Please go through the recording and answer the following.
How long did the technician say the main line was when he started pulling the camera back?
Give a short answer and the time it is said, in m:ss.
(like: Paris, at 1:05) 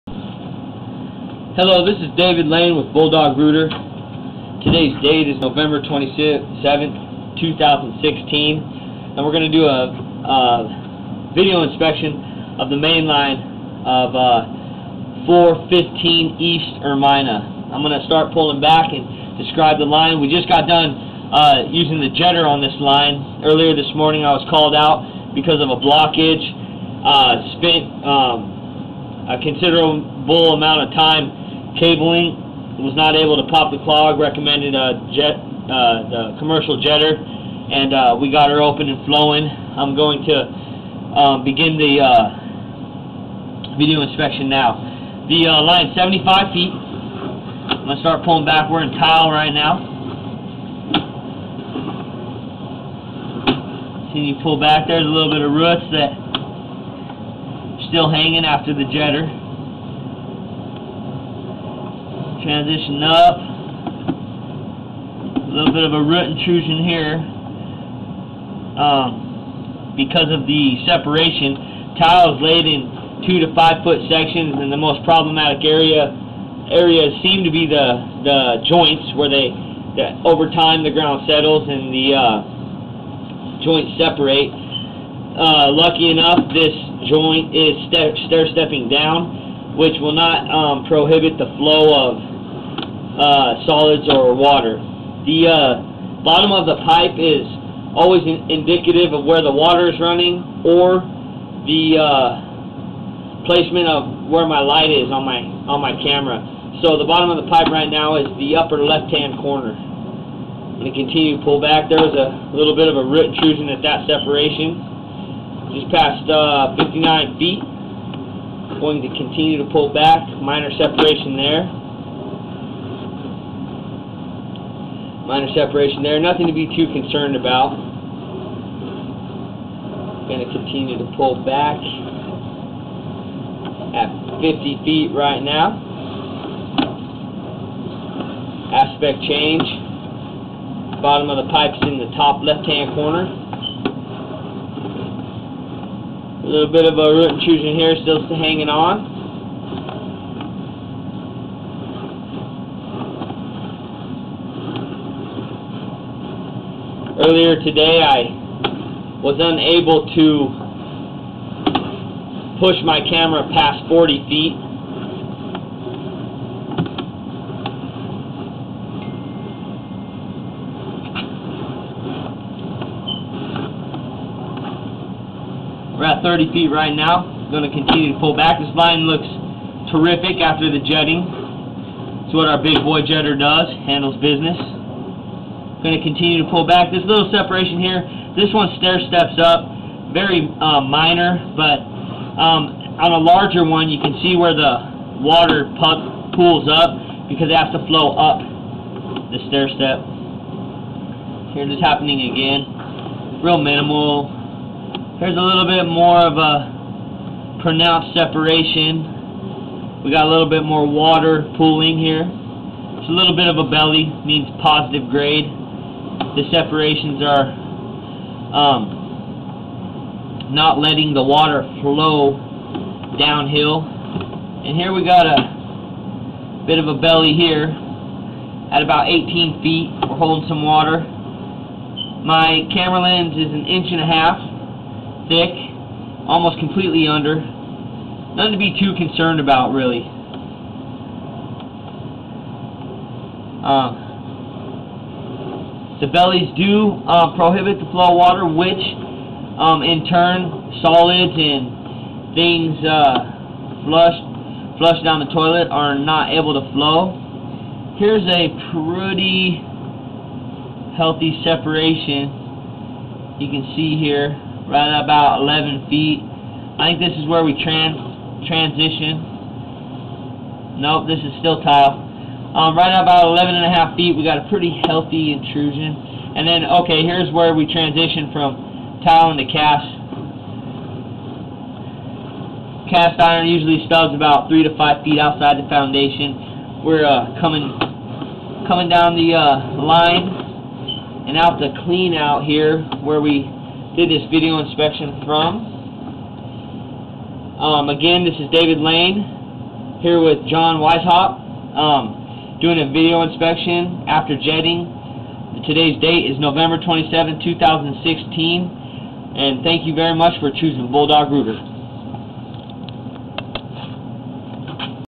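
75 feet, at 0:45.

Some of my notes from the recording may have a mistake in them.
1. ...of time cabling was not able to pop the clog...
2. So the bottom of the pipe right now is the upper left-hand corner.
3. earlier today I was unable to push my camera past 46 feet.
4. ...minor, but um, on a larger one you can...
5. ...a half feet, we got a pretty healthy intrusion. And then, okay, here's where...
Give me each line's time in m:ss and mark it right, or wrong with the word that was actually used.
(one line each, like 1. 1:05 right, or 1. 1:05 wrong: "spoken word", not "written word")
1. 0:30 right
2. 1:46 right
3. 2:37 wrong: "40", not "46"
4. 3:10 right
5. 4:33 right.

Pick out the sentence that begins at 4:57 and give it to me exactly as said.
Um, again, this is David Lane here with John Weishaupt.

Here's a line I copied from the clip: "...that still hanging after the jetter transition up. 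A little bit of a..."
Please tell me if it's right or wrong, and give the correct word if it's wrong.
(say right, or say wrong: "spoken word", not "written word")
right.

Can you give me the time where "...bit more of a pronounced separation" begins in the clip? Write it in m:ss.
3:25.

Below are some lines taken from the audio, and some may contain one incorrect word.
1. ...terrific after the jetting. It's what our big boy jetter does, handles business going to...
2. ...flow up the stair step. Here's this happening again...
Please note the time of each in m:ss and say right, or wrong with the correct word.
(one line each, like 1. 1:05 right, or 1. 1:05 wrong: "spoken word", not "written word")
1. 2:59 right
2. 3:17 right.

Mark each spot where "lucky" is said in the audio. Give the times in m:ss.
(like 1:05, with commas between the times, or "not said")
1:25.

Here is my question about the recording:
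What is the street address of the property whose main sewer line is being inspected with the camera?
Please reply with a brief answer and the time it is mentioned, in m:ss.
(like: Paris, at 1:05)
415 East Ermina, at 0:15.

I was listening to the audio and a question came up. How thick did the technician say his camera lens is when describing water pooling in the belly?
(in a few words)
An inch and a half.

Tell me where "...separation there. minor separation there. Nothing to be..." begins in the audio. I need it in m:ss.
2:00.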